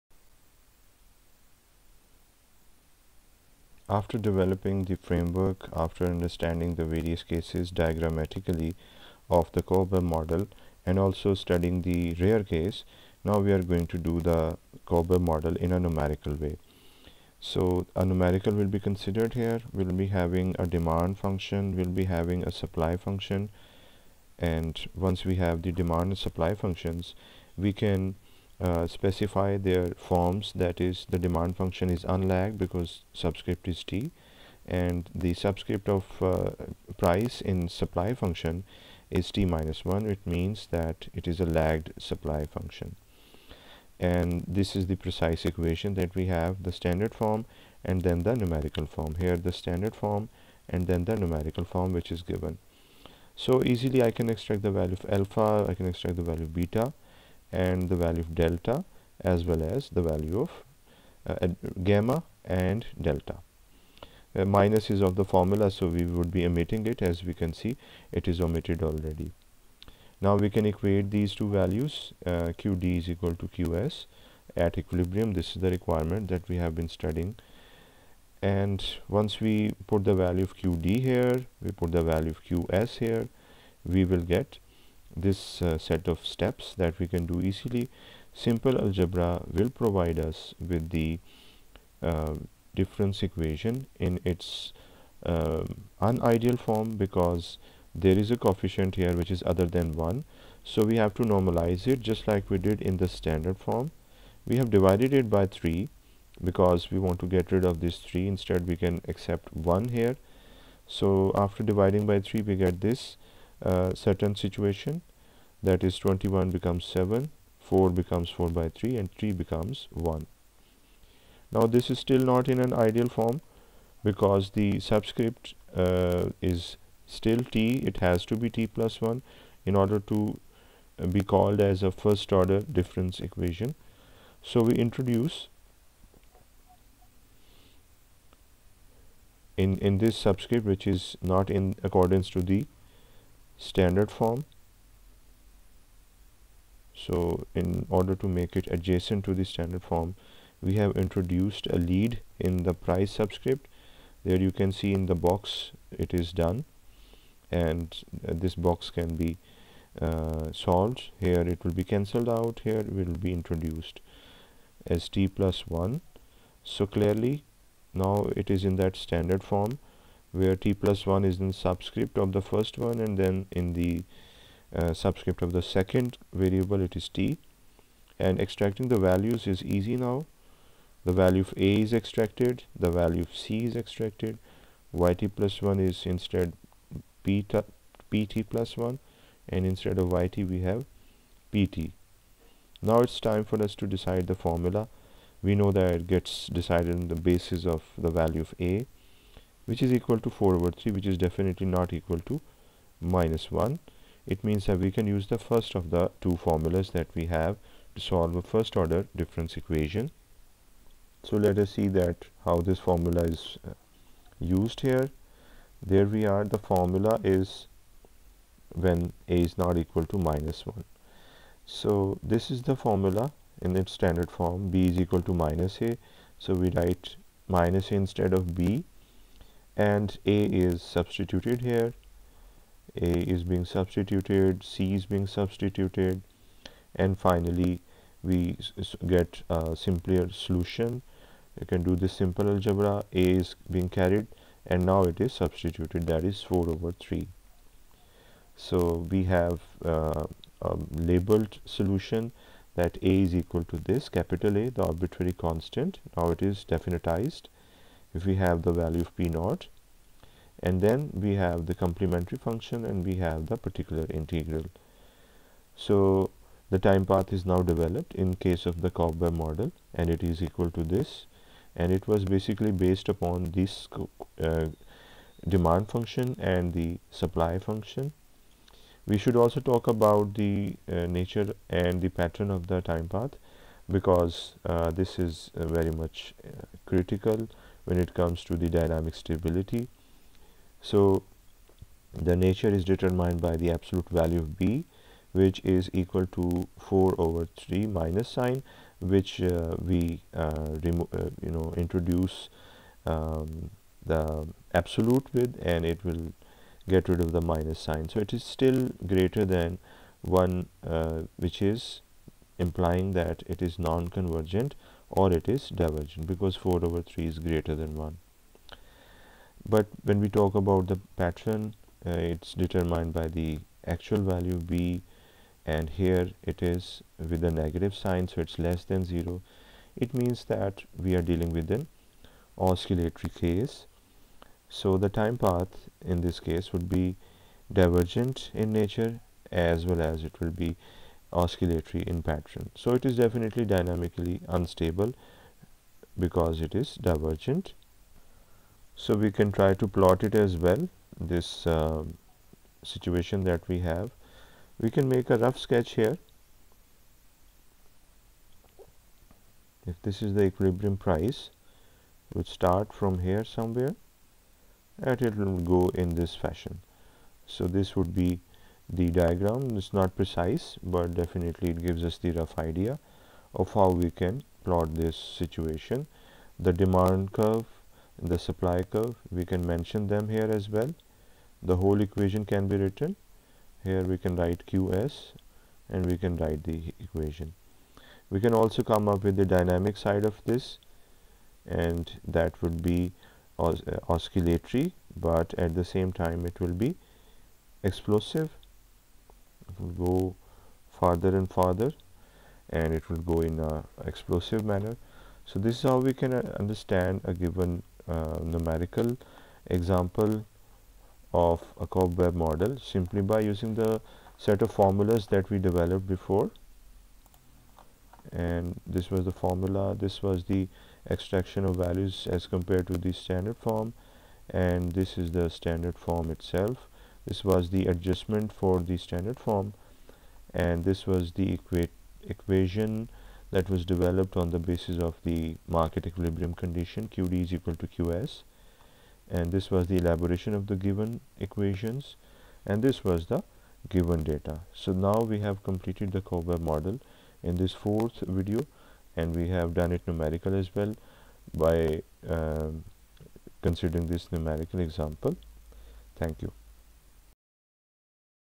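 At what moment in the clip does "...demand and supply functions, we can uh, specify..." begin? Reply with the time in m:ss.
0:25.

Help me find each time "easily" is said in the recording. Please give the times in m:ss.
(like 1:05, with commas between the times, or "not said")
0:53, 1:27.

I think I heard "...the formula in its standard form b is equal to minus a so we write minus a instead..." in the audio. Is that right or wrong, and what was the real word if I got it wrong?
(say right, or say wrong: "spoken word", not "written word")
right.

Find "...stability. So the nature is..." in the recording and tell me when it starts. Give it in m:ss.
4:49.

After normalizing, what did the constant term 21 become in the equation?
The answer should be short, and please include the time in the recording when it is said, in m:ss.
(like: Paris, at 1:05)
7, at 1:55.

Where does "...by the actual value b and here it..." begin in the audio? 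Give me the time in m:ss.
5:23.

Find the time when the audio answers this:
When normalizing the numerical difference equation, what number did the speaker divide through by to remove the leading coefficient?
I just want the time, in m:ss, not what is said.
1:44.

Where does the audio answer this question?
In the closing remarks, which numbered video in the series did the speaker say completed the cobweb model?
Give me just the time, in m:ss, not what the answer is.
7:27.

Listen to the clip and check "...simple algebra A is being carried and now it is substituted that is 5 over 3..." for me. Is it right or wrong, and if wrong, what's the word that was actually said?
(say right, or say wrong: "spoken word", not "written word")
wrong: "4", not "5".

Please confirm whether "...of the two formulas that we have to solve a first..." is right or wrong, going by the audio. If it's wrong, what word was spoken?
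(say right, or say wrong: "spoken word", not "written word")
right.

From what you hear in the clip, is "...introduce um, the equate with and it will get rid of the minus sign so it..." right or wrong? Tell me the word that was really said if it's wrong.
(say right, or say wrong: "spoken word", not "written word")
wrong: "absolute", not "equate".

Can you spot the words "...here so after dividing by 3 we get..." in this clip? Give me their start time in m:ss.
1:49.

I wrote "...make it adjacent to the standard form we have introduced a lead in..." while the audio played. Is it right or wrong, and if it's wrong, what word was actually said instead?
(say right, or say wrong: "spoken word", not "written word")
right.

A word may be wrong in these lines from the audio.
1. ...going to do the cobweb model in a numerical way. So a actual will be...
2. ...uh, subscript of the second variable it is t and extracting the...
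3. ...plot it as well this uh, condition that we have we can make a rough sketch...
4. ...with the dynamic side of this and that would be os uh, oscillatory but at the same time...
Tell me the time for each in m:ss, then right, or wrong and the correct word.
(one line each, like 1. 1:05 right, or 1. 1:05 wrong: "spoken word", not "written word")
1. 0:13 wrong: "numerical", not "actual"
2. 2:54 right
3. 5:49 wrong: "situation", not "condition"
4. 6:29 right.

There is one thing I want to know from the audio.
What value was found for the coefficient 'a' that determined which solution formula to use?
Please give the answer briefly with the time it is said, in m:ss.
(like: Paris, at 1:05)
4/3, at 3:20.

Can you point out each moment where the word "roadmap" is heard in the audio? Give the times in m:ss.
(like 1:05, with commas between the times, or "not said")
not said.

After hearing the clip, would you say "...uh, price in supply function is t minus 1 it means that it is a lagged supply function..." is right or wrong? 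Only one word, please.
right.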